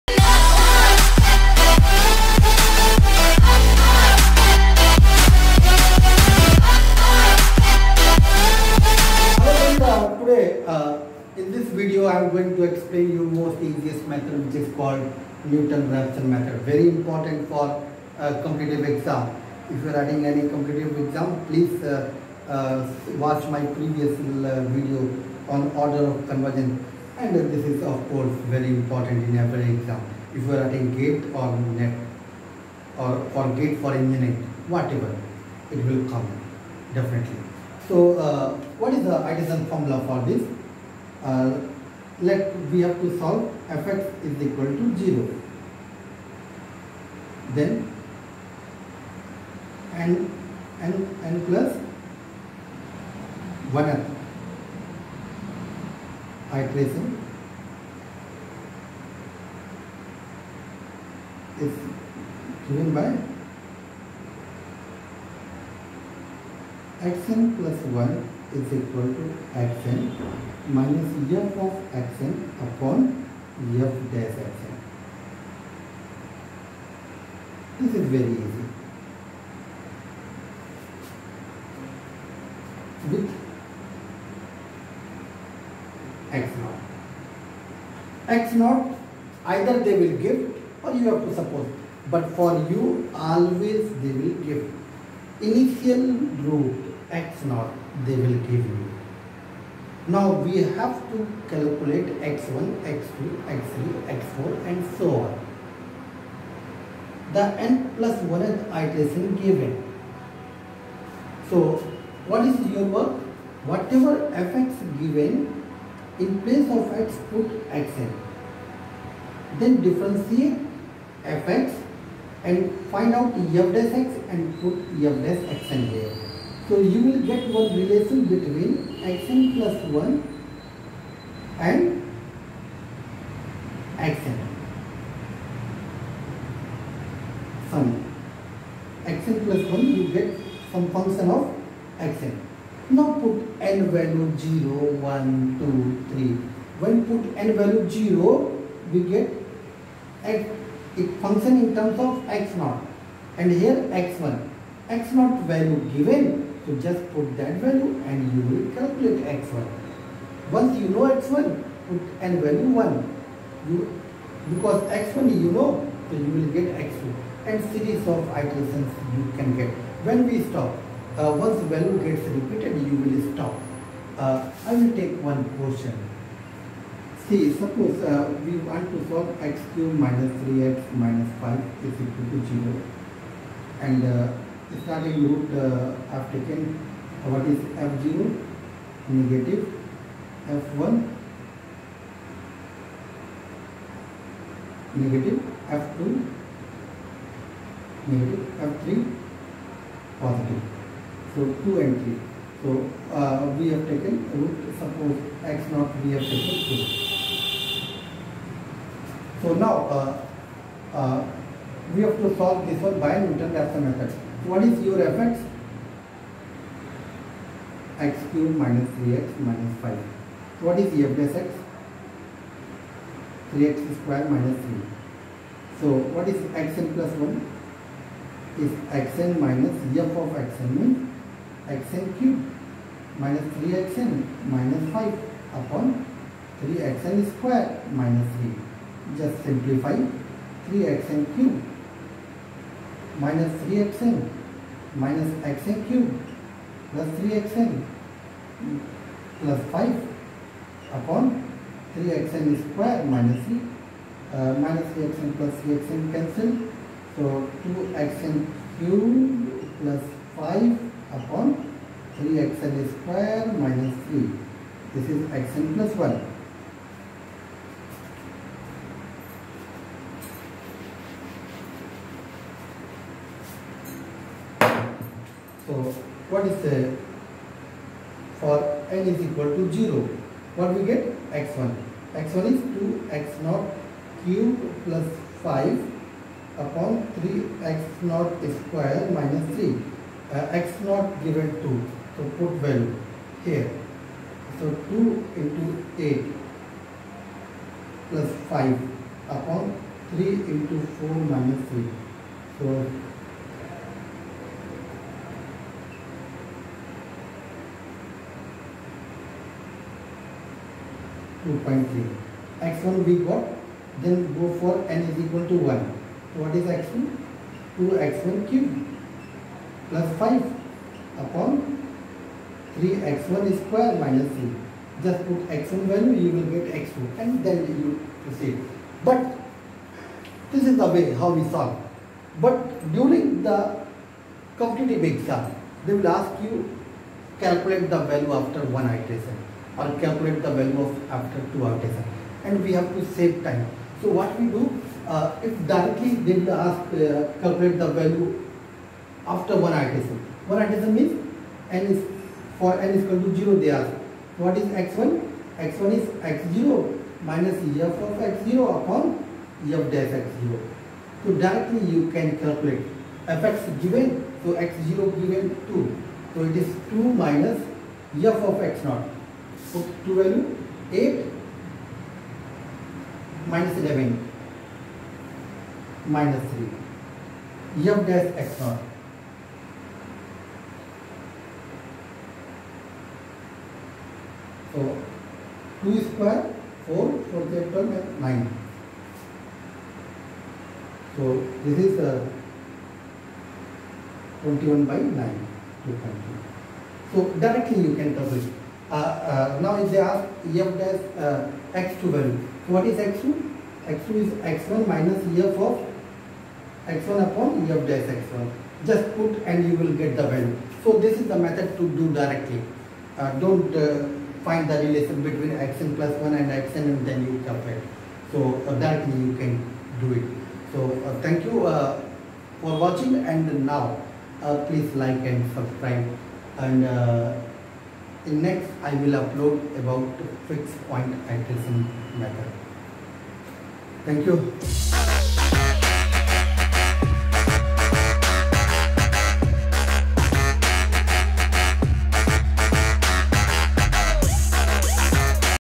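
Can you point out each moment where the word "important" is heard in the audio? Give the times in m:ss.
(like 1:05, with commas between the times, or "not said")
0:16, 0:28.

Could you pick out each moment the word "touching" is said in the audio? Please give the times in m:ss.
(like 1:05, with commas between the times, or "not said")
not said.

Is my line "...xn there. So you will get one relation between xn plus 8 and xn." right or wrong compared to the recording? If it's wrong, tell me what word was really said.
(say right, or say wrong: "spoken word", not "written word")
wrong: "1", not "8".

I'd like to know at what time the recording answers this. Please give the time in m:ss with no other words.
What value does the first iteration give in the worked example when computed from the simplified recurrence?
5:11.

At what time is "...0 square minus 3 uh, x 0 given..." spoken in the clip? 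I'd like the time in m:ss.
4:48.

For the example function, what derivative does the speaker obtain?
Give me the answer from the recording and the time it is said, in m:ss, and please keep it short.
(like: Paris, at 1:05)
3x^2 - 3, at 3:43.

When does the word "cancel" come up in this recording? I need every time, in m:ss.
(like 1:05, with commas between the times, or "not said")
4:16.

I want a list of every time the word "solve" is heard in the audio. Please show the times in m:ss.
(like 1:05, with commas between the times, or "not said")
0:43, 2:59, 3:32, 5:31.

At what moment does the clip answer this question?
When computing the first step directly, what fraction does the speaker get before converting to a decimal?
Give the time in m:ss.
6:34.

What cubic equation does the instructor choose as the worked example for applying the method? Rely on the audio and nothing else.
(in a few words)
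x^3 - 3x - 5 = 0.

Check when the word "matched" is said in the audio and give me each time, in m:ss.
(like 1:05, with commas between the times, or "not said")
not said.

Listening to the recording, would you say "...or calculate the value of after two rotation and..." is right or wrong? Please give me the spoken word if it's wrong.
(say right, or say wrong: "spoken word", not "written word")
right.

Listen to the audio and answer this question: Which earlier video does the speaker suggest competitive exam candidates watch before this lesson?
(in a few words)
Order of convergence.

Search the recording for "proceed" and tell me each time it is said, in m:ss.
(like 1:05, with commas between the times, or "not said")
5:28.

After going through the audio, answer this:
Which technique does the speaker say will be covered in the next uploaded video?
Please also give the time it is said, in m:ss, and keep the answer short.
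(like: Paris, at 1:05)
Fixed point iteration method, at 7:10.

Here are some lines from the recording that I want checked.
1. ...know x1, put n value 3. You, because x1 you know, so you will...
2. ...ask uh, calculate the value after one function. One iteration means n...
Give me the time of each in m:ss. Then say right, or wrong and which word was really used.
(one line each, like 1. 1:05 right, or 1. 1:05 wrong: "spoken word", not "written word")
1. 2:40 wrong: "1", not "3"
2. 5:46 wrong: "iteration", not "function".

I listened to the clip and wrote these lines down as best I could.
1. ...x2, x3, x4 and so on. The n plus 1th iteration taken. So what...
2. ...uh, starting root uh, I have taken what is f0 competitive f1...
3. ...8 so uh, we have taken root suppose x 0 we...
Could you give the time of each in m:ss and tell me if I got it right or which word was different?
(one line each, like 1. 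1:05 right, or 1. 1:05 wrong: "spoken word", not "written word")
1. 1:42 wrong: "given", not "taken"
2. 3:04 wrong: "negative", not "competitive"
3. 3:22 wrong: "3", not "8".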